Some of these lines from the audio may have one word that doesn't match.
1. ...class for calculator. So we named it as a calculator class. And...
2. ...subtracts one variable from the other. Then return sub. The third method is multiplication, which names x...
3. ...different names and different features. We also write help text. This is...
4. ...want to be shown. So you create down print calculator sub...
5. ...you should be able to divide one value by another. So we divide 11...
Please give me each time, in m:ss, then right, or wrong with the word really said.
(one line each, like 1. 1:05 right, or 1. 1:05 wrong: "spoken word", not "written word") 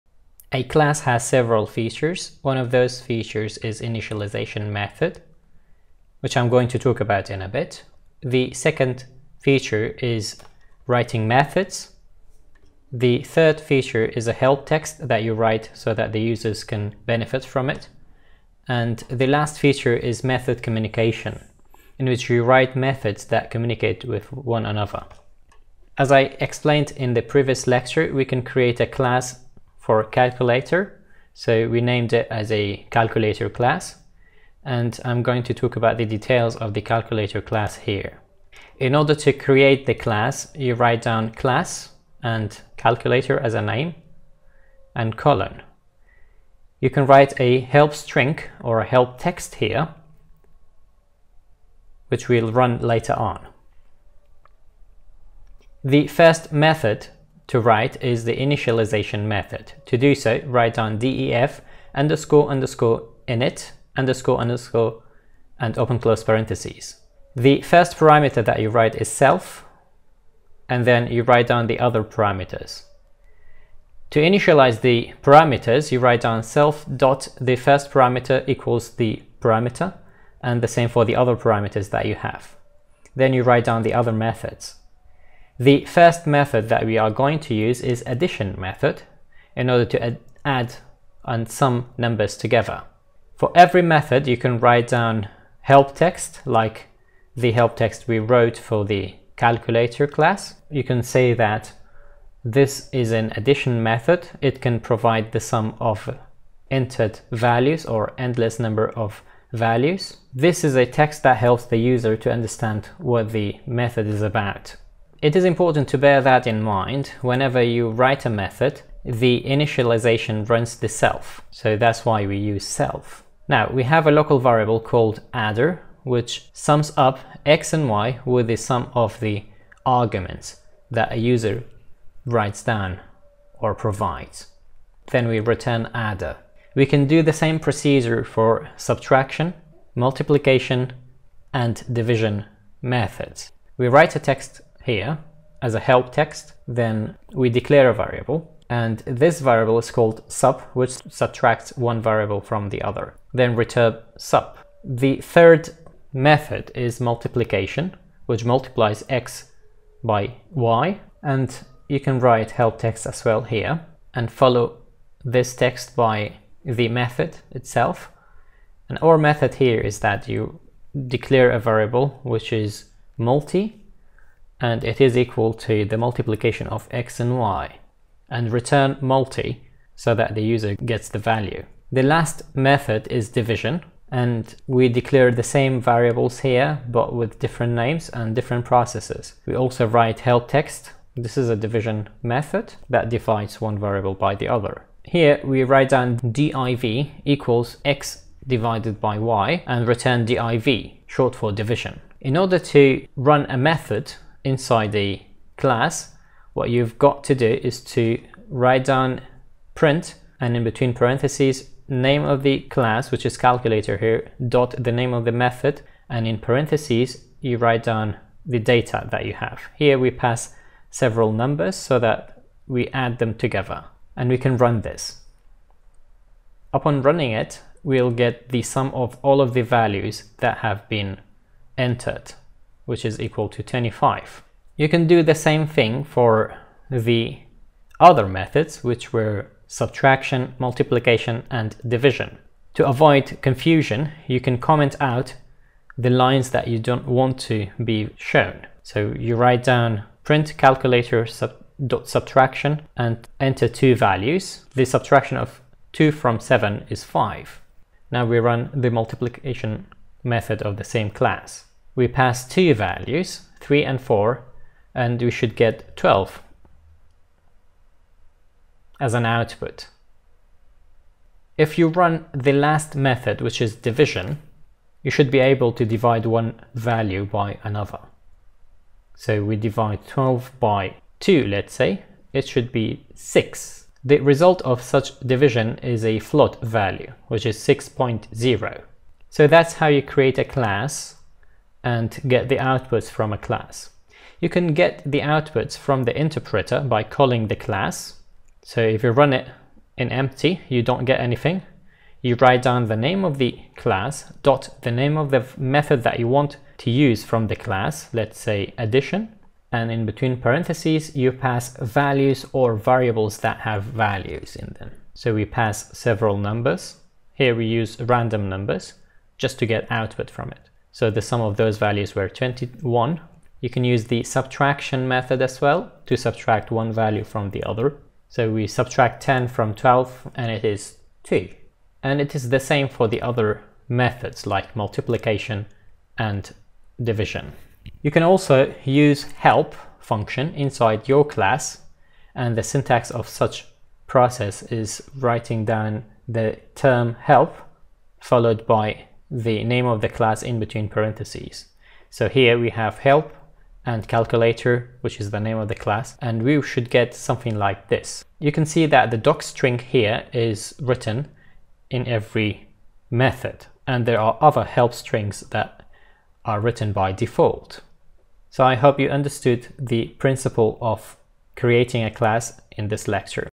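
1. 0:28 right
2. 2:31 wrong: "multiplies", not "names"
3. 3:07 wrong: "processes", not "features"
4. 4:07 wrong: "write", not "create"
5. 4:35 wrong: "12", not "11".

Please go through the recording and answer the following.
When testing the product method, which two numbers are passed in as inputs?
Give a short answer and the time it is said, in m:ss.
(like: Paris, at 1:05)
3 and 4, at 4:23.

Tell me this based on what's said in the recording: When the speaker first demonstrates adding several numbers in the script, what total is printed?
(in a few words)
25.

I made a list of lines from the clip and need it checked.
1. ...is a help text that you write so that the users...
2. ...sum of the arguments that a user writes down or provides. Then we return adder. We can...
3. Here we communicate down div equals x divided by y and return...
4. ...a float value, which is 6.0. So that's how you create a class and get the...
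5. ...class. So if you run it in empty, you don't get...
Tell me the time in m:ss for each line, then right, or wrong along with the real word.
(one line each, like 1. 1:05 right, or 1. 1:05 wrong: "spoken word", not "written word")
1. 0:14 right
2. 2:08 right
3. 3:15 wrong: "write", not "communicate"
4. 4:46 right
5. 4:57 right.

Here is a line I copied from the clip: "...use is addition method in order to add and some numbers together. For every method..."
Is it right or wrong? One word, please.
right.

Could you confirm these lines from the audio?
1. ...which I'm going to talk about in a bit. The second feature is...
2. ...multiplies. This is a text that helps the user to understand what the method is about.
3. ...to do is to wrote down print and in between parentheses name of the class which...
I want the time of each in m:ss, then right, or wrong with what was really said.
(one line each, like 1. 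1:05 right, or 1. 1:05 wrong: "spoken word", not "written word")
1. 0:06 right
2. 1:49 wrong: "values", not "multiplies"
3. 3:27 wrong: "write", not "wrote".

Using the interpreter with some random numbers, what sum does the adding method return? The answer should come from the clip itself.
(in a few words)
21.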